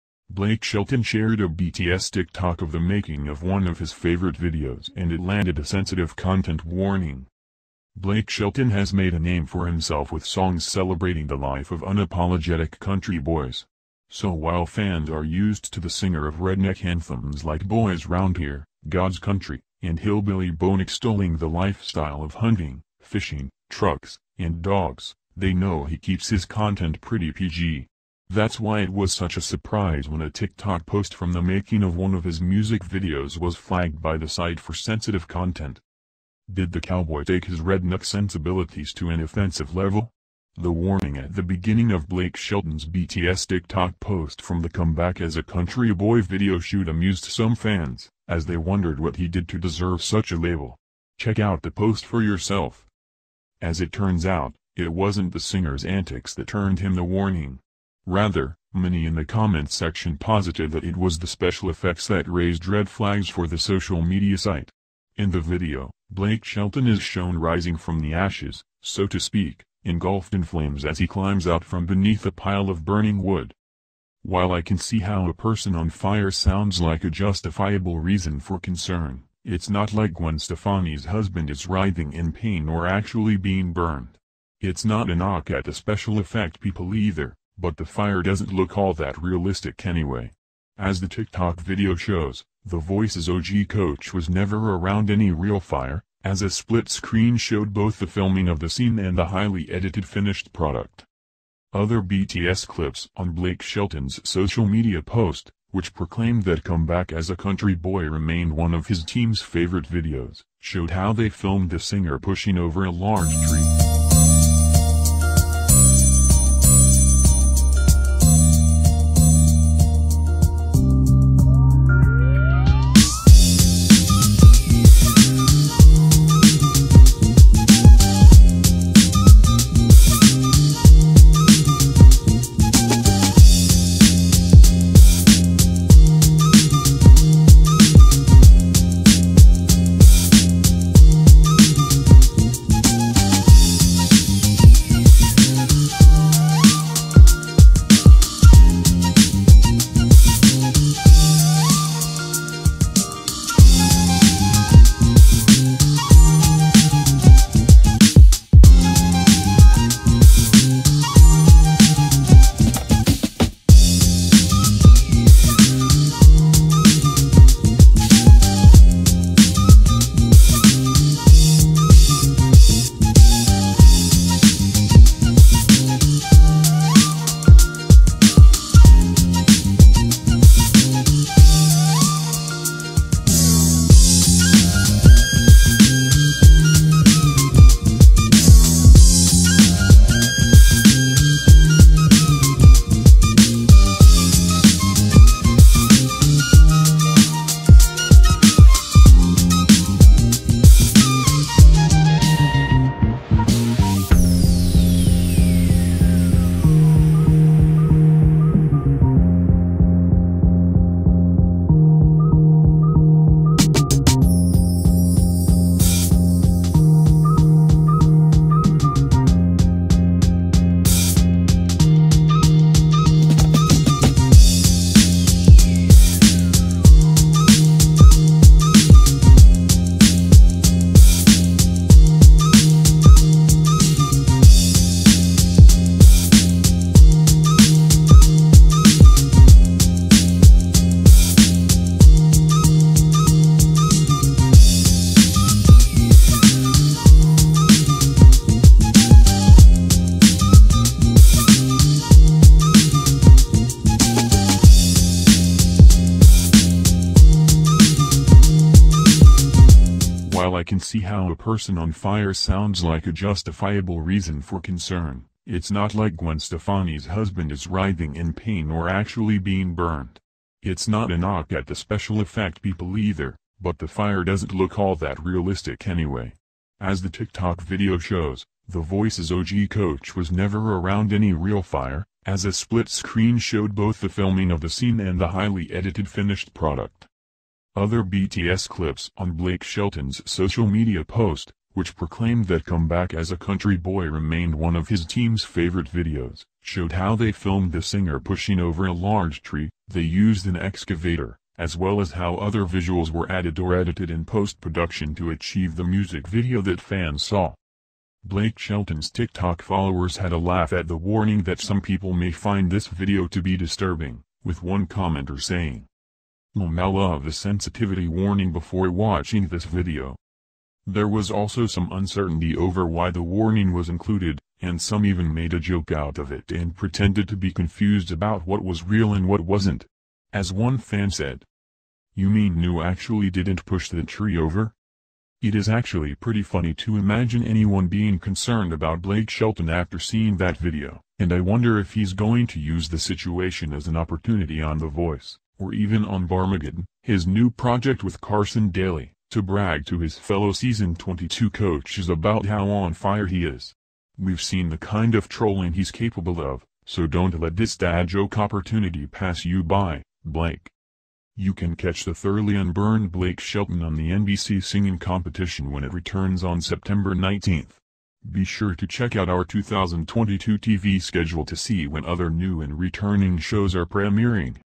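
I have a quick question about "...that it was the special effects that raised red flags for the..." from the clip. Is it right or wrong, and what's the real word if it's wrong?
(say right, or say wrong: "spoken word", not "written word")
right.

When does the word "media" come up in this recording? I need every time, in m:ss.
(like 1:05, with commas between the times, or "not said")
1:04, 1:44, 4:50.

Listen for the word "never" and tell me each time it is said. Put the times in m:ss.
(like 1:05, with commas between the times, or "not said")
1:34, 4:40.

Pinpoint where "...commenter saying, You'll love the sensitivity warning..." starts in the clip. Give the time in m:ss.
5:14.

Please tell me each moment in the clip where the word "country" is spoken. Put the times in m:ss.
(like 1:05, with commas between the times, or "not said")
0:12, 0:19, 0:45, 1:47, 4:53.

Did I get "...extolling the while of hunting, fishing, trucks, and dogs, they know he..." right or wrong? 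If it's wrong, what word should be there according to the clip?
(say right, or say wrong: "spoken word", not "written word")
wrong: "lifestyle", not "while".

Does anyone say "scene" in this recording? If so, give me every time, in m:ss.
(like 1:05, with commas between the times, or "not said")
1:38, 4:44.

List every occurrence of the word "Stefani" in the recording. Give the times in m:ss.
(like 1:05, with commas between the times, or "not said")
1:20, 4:26.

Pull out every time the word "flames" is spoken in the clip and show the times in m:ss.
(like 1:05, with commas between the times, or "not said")
1:10.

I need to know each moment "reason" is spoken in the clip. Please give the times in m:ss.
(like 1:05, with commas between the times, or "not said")
1:17, 4:24.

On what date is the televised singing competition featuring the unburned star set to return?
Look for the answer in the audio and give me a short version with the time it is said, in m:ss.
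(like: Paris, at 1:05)
September 19, at 6:06.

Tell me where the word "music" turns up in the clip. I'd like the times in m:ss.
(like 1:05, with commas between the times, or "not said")
0:32, 5:05.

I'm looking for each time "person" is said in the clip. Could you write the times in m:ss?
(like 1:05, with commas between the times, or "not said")
1:15, 4:21.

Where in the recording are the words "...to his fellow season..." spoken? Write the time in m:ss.
5:49.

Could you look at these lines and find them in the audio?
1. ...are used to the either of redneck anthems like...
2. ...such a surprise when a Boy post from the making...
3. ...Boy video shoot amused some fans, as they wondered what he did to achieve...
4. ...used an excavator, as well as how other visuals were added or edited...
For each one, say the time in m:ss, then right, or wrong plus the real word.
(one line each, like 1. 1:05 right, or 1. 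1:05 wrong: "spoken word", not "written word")
1. 0:15 wrong: "singer", not "either"
2. 0:29 wrong: "TikTok", not "Boy"
3. 0:45 wrong: "deserve", not "achieve"
4. 5:00 right.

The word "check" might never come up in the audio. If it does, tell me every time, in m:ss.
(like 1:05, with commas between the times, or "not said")
0:51, 6:08.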